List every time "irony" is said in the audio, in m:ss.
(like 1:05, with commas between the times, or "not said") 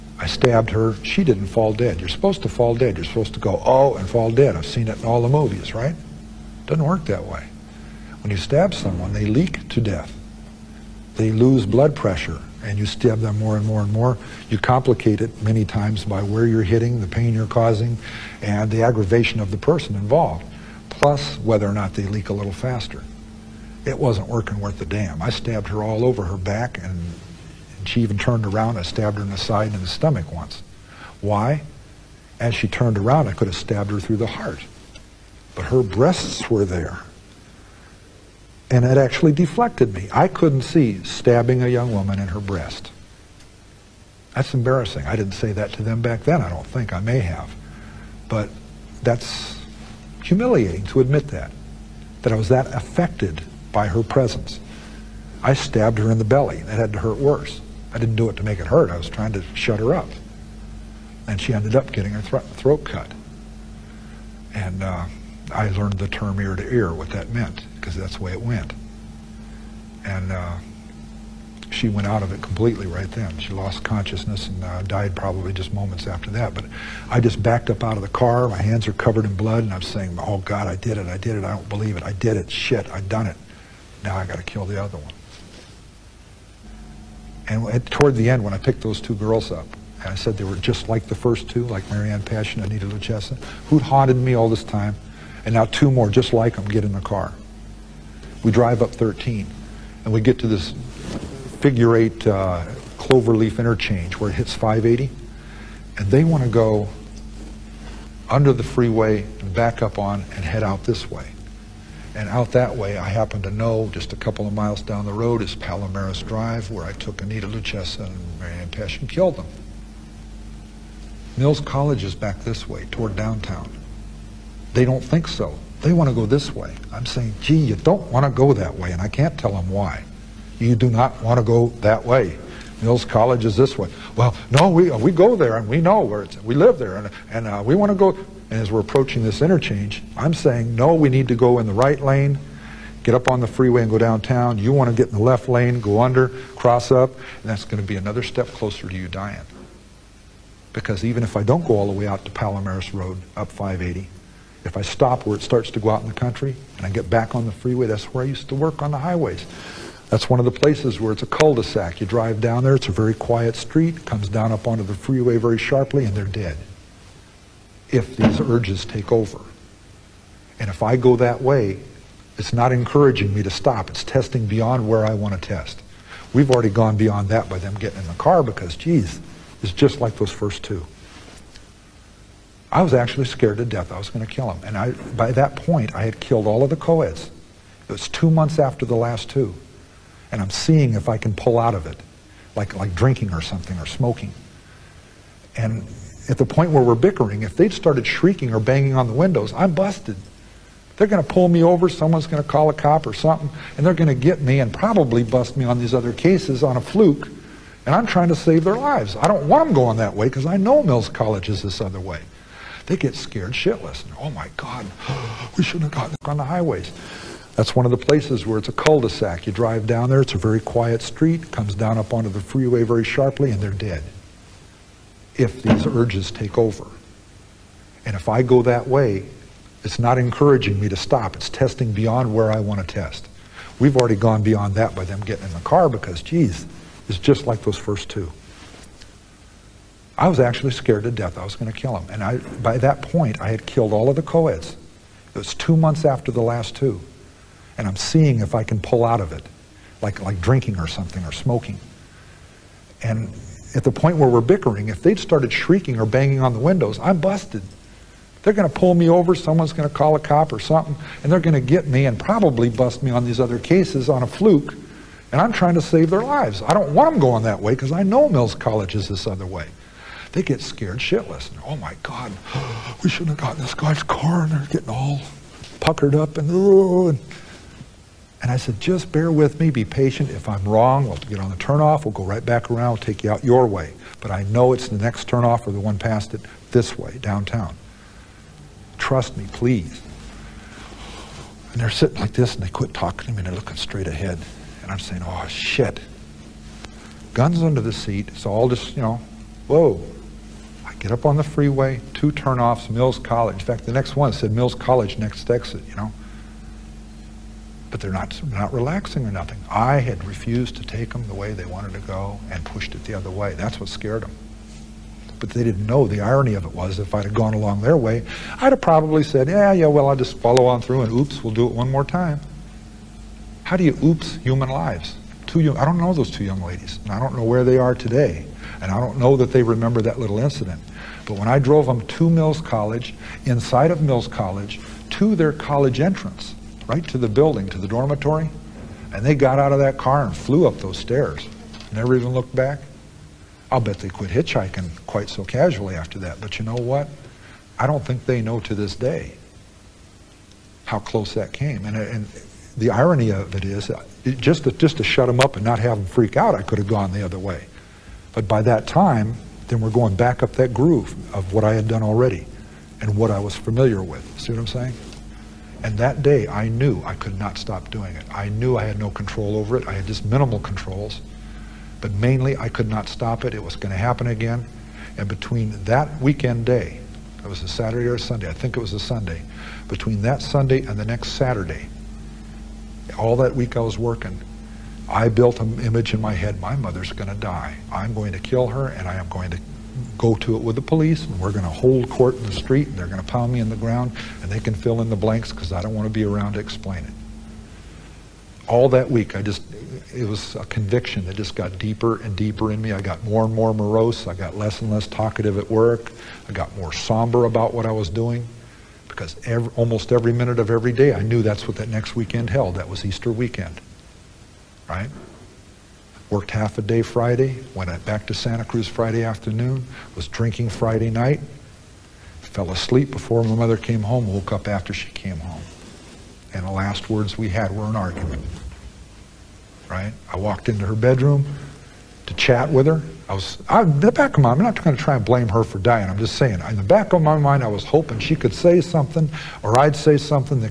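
5:16, 5:52.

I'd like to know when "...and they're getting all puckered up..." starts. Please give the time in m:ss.
4:34.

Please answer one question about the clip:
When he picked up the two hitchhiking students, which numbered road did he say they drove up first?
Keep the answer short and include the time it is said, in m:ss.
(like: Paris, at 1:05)
13, at 1:38.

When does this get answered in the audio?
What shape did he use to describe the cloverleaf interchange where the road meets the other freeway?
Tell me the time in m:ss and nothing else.
1:41.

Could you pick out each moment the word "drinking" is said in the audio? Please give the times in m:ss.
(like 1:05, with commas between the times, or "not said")
3:12, 4:10, 7:00.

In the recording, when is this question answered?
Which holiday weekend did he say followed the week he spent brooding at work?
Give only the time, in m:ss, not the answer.
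6:53.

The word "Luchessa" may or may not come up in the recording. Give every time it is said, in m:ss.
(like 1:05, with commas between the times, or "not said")
1:32, 1:57.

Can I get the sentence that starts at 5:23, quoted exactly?
How do you oops human lives?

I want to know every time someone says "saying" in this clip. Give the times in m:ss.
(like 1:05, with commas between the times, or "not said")
1:19, 2:07, 2:20, 4:54, 6:04, 7:16.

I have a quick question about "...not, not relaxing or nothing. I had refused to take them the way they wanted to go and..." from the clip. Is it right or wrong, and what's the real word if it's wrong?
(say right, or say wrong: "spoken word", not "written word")
right.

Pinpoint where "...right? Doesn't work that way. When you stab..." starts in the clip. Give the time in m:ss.
0:05.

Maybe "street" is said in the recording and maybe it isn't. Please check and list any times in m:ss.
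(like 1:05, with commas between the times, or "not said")
2:43, 3:41, 6:32.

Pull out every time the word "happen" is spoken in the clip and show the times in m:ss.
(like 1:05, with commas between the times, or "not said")
1:53, 6:13.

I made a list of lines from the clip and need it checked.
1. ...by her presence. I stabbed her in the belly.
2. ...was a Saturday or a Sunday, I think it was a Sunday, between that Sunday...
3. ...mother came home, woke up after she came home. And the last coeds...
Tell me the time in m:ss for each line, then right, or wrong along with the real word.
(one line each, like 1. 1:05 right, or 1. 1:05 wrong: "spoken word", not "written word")
1. 0:53 right
2. 6:17 right
3. 7:03 wrong: "words", not "coeds".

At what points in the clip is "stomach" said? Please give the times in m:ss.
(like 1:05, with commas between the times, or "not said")
0:29.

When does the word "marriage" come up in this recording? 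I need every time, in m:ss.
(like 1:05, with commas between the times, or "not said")
not said.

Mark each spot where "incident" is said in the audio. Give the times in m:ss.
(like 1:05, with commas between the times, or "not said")
5:30.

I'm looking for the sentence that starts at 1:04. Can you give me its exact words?
And uh, I learned the term ear to ear, what that meant, because that's the way it went.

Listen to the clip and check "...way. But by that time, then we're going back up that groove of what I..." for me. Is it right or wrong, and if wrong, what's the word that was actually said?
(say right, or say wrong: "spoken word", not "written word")
right.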